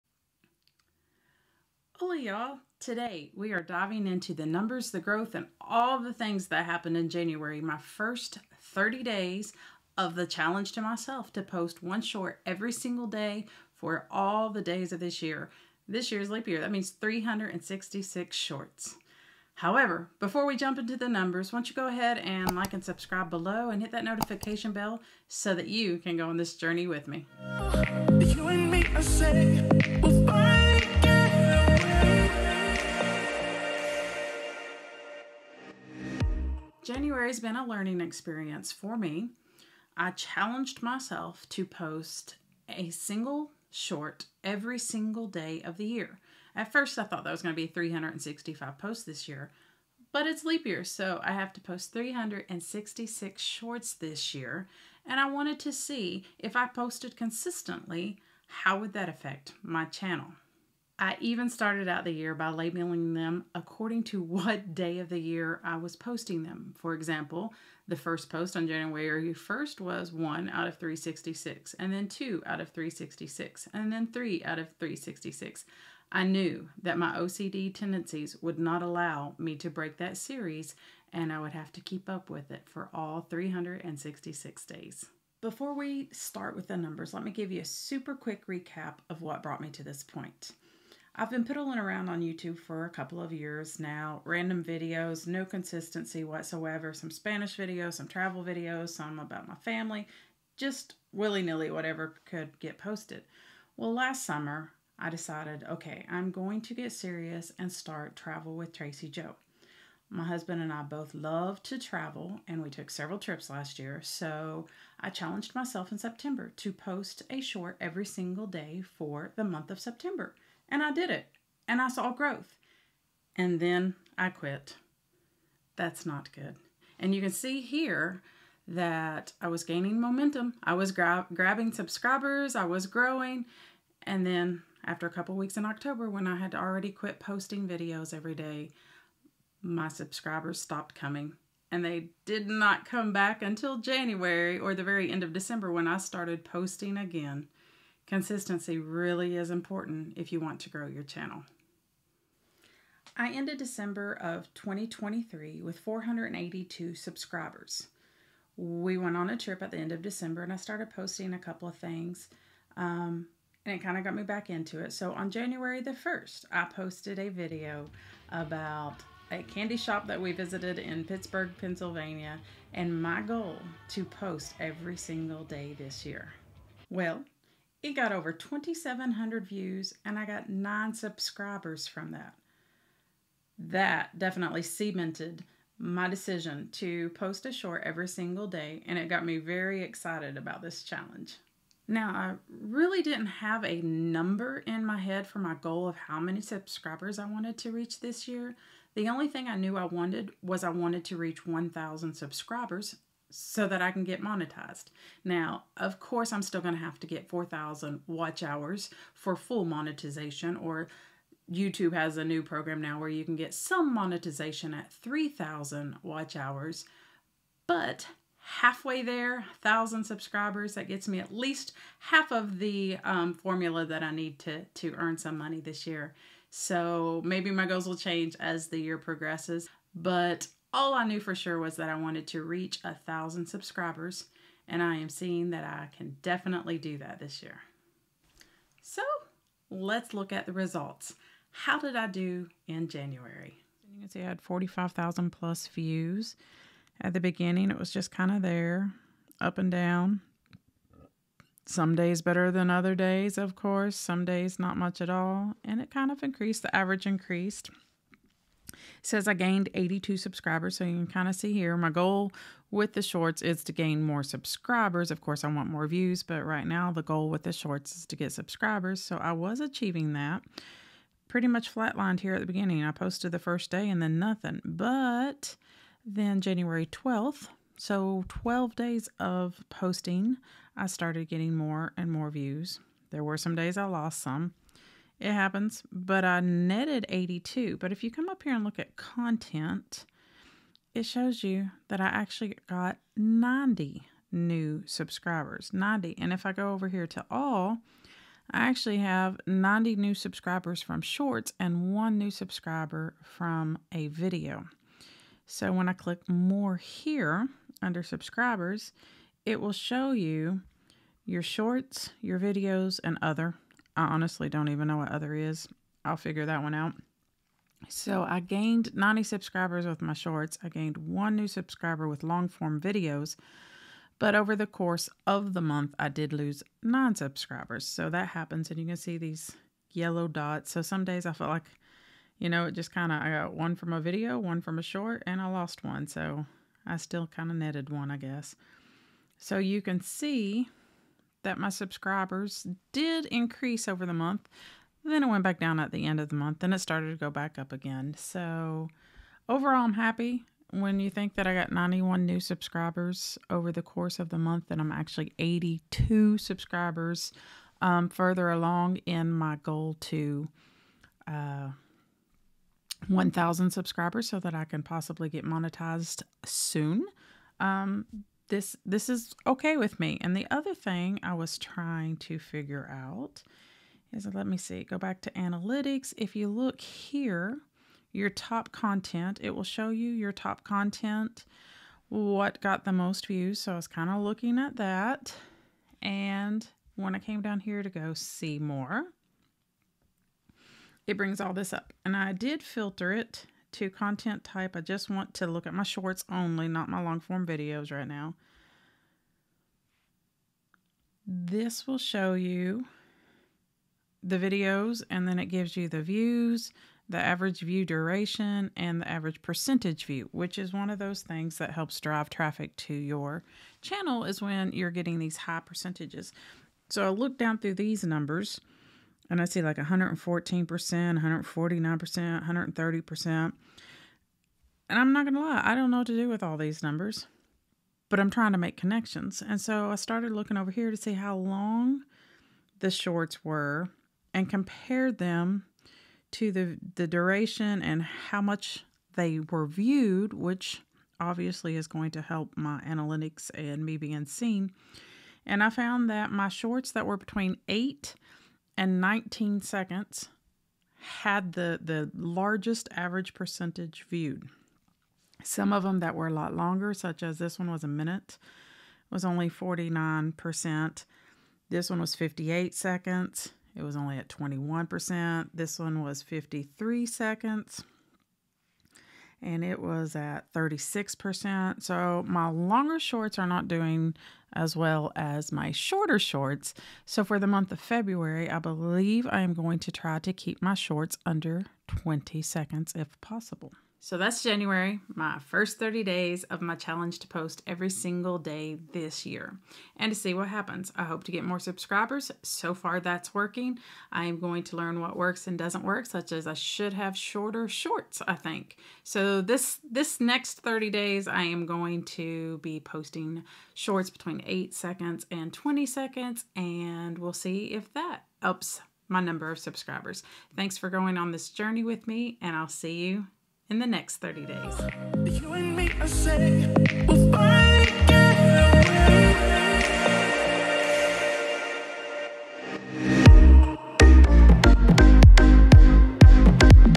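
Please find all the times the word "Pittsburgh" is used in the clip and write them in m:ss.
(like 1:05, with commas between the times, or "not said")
2:51.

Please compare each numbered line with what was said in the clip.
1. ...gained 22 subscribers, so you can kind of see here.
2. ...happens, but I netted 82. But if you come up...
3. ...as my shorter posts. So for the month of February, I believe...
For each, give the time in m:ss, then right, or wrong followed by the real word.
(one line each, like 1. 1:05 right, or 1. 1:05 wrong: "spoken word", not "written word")
1. 4:19 wrong: "82", not "22"
2. 4:45 right
3. 7:55 wrong: "shorts", not "posts".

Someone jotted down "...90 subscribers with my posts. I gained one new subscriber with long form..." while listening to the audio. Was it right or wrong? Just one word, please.
wrong.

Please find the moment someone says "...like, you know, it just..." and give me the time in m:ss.
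5:31.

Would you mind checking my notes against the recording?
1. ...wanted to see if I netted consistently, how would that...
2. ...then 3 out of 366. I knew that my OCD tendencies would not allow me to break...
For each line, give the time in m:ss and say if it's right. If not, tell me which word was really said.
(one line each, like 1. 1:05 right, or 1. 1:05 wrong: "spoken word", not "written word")
1. 0:55 wrong: "posted", not "netted"
2. 1:13 right.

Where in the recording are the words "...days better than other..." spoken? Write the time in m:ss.
4:11.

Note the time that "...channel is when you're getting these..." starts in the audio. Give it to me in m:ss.
6:53.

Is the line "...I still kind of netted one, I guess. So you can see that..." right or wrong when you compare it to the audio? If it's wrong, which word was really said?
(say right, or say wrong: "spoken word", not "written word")
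right.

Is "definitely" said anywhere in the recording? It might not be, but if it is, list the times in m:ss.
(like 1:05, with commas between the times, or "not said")
3:04, 3:56.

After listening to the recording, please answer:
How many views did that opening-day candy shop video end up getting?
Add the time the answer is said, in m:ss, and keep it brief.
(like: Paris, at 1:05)
Over 2,700, at 2:58.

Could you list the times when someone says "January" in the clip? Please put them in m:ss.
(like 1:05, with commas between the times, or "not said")
0:07, 0:36, 1:08, 2:23, 2:45, 4:02, 4:36, 8:04.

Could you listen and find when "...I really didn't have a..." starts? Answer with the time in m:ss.
3:12.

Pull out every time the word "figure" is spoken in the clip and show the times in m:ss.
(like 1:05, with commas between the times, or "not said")
5:16, 6:12.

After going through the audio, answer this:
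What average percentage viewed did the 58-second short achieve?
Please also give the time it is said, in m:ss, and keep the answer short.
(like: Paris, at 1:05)
21%, at 7:44.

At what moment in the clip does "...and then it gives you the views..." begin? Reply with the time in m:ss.
6:45.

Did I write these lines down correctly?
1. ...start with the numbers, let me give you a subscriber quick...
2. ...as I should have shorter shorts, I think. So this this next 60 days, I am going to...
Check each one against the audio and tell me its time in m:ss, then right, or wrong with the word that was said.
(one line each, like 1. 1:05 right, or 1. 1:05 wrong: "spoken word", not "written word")
1. 1:26 wrong: "super", not "subscriber"
2. 8:16 wrong: "30", not "60".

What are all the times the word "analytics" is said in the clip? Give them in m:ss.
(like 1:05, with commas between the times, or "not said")
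6:15, 7:22.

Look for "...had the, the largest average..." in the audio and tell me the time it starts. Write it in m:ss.
7:31.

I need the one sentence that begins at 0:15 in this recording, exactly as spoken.
This year's leap year, that means 366 shorts.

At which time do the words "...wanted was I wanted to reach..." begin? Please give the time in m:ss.
3:19.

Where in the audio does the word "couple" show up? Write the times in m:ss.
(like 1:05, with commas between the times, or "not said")
1:32, 2:15, 2:41.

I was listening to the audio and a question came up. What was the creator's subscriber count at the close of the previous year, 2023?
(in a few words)
482.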